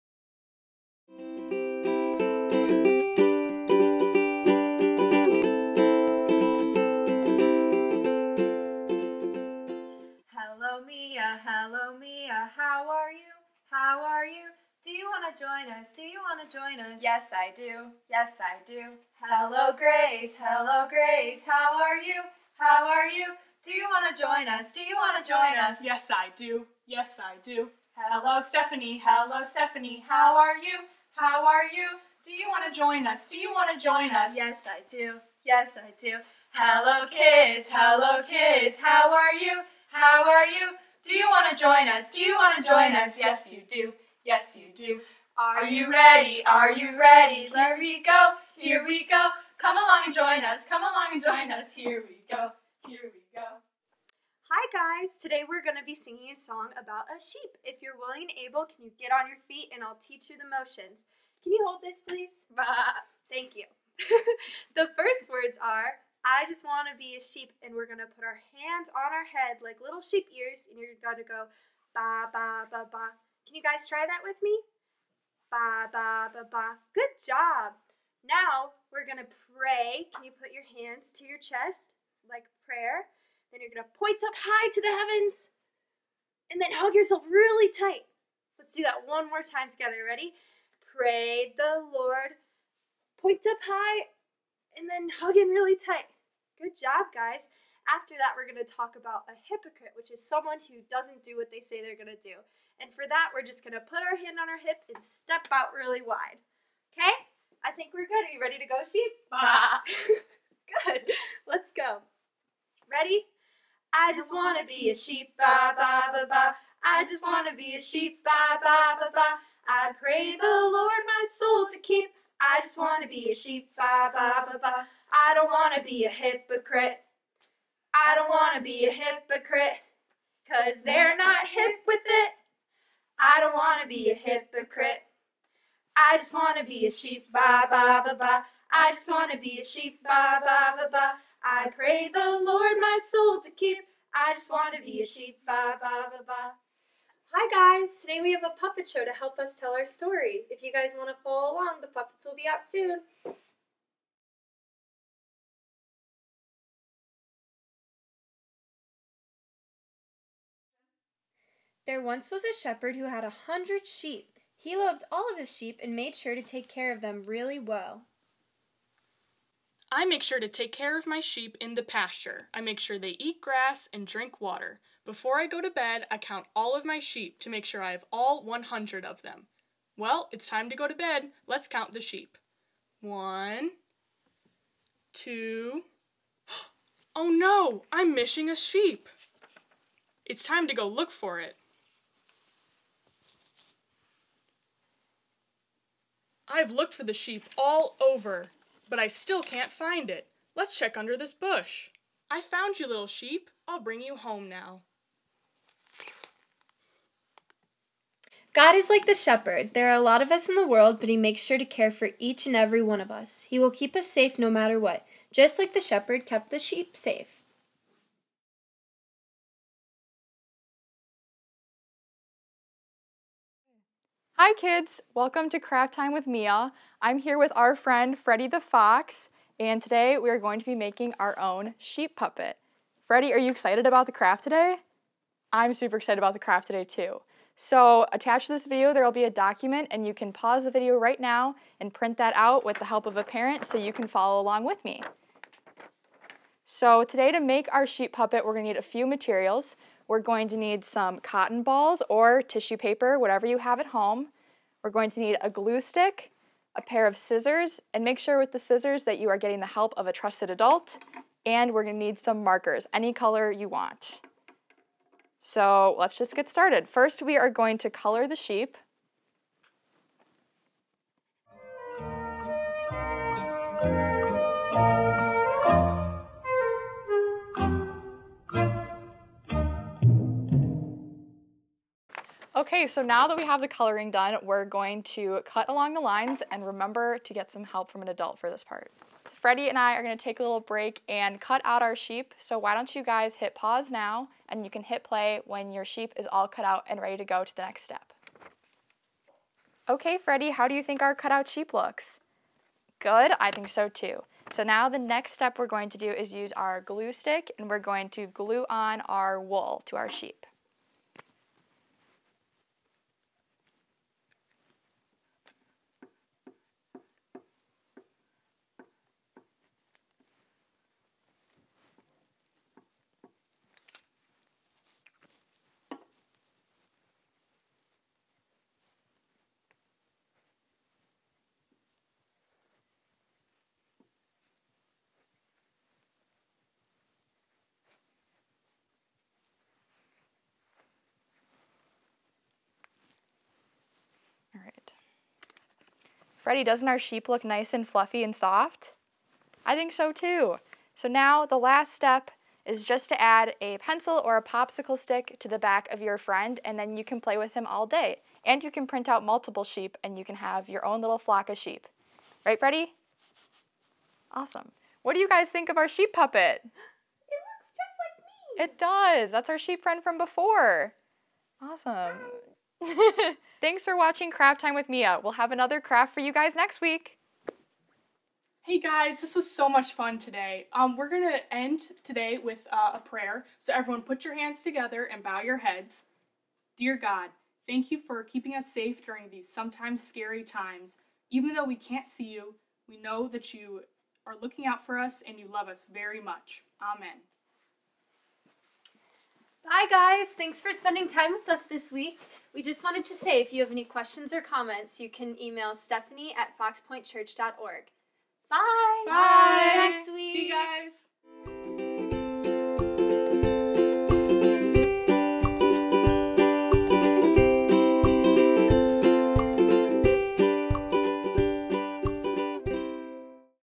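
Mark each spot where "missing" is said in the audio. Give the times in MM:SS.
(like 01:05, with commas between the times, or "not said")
03:08.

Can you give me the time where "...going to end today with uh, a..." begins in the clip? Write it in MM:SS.
06:21.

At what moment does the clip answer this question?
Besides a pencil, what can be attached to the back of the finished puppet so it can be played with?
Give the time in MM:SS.
05:54.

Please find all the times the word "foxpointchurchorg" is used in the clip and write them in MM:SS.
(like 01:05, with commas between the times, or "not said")
06:46.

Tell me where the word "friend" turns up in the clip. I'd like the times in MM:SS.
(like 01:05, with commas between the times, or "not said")
03:47, 05:56, 06:09.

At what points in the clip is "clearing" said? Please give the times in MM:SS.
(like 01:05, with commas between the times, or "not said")
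not said.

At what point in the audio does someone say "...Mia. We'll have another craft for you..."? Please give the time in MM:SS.
06:14.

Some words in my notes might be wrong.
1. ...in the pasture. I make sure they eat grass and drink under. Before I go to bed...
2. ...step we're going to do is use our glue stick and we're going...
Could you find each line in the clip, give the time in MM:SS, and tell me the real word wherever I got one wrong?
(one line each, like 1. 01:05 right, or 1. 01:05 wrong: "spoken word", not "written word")
1. 02:51 wrong: "water", not "under"
2. 05:05 right.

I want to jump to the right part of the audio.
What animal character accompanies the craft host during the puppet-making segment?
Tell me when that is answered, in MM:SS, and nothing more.
03:48.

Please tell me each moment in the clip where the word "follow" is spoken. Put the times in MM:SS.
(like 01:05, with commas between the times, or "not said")
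02:31, 04:04.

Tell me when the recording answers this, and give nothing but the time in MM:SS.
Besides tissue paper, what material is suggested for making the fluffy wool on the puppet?
04:11.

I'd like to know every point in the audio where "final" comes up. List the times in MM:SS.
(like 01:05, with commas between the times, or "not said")
not said.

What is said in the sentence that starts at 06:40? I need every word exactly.
Thanks for spending time with us this week.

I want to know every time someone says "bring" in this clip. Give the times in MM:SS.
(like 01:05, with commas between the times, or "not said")
03:23.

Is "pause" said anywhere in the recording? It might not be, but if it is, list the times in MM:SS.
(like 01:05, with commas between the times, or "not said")
04:00, 04:53.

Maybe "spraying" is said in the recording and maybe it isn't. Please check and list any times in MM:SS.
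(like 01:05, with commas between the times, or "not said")
not said.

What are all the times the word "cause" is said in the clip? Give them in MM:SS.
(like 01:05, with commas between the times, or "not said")
02:10.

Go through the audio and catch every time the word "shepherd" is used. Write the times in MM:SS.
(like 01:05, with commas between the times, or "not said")
02:42, 03:29, 03:35.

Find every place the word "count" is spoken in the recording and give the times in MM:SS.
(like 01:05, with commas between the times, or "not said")
02:56, 03:01.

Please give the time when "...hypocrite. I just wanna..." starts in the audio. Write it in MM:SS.
02:14.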